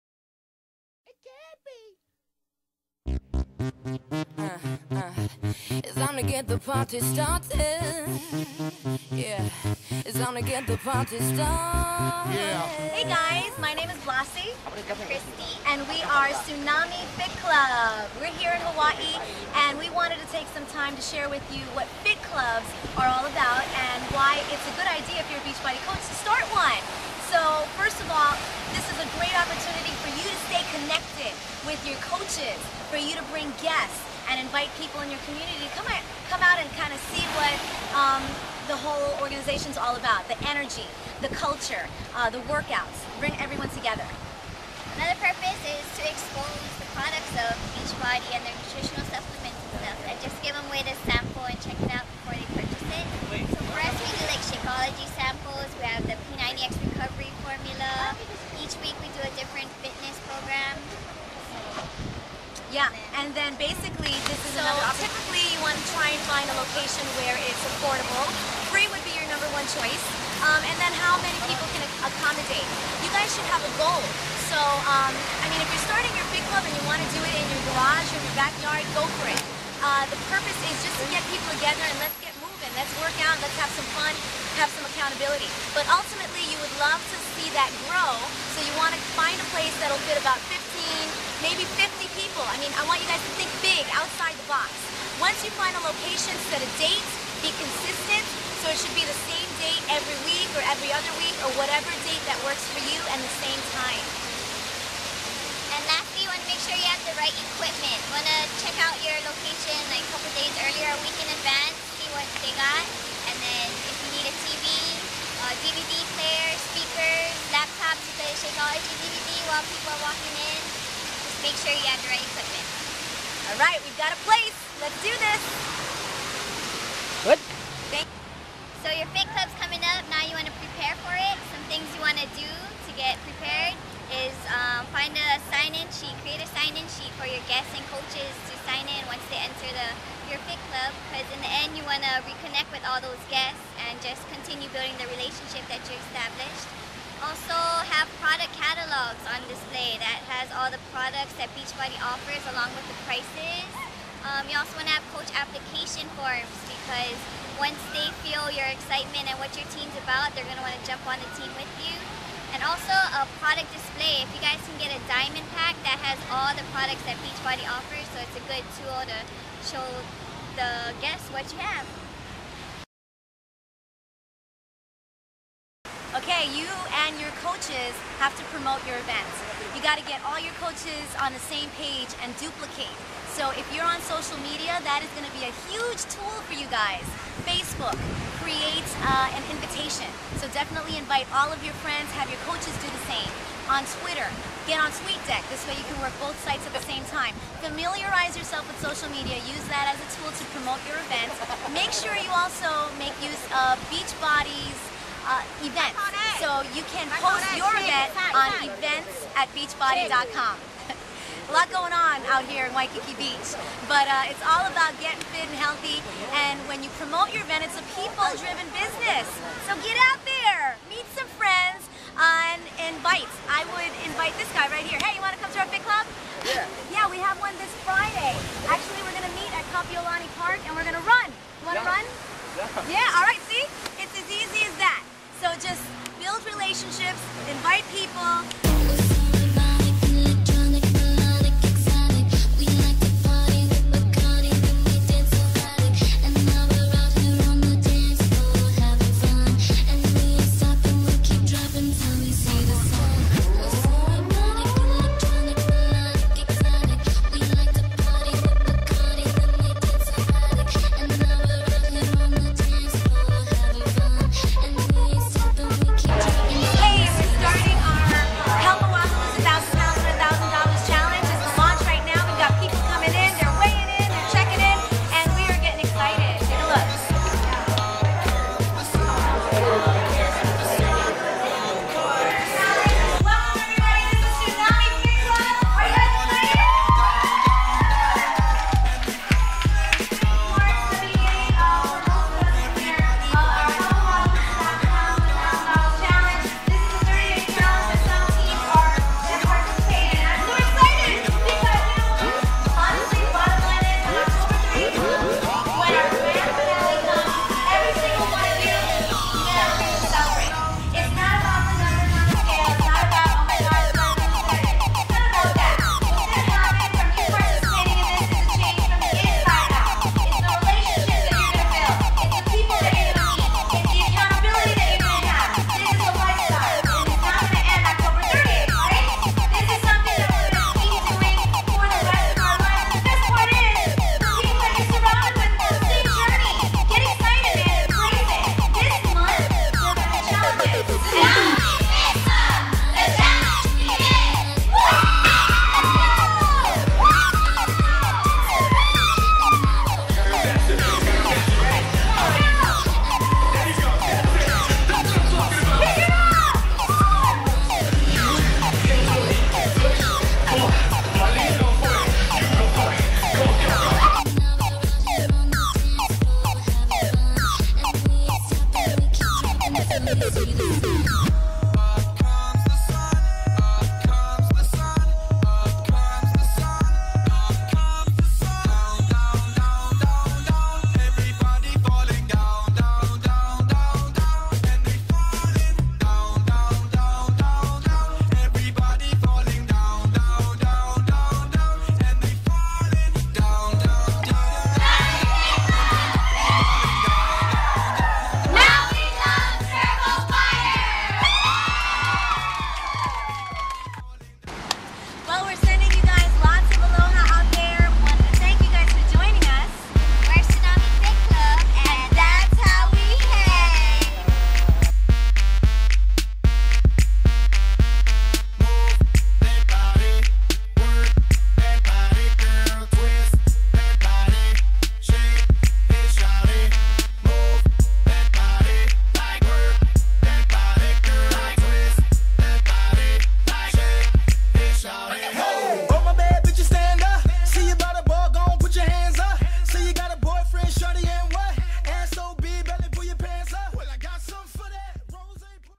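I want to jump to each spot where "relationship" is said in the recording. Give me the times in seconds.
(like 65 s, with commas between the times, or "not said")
145 s, 236 s.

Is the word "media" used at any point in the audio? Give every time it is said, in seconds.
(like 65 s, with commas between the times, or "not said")
184 s, 199 s.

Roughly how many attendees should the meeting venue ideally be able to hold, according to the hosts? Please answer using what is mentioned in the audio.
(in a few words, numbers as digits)
50.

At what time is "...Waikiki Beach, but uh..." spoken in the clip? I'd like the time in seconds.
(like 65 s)
212 s.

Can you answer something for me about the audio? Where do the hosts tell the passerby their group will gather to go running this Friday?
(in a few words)
Kapiolani Park.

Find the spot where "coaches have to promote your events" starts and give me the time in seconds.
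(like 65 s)
177 s.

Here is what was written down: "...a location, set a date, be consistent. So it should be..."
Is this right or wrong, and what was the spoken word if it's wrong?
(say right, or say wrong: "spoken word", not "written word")
right.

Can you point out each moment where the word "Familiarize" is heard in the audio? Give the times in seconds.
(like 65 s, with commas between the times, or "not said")
197 s.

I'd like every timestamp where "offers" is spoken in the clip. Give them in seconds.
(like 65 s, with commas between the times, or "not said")
152 s, 167 s.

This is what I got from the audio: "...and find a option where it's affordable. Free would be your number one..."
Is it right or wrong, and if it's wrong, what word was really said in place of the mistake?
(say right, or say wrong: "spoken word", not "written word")
wrong: "location", not "option".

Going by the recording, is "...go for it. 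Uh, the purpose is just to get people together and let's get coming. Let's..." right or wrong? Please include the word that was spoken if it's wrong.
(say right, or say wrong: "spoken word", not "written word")
wrong: "moving", not "coming".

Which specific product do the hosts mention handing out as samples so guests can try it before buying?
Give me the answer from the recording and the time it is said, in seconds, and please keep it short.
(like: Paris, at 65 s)
Shakeology, at 54 s.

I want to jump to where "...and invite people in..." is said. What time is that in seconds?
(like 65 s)
34 s.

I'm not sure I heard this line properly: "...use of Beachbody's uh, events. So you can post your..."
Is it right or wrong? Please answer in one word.
right.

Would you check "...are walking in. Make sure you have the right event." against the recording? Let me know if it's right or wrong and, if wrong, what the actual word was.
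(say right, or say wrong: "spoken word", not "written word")
wrong: "equipment", not "event".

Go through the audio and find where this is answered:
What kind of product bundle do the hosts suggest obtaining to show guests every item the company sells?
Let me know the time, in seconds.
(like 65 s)
165 s.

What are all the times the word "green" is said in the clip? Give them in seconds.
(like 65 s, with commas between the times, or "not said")
not said.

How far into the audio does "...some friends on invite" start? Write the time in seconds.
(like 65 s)
221 s.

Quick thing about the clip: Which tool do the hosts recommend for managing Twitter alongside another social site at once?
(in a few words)
TweetDeck.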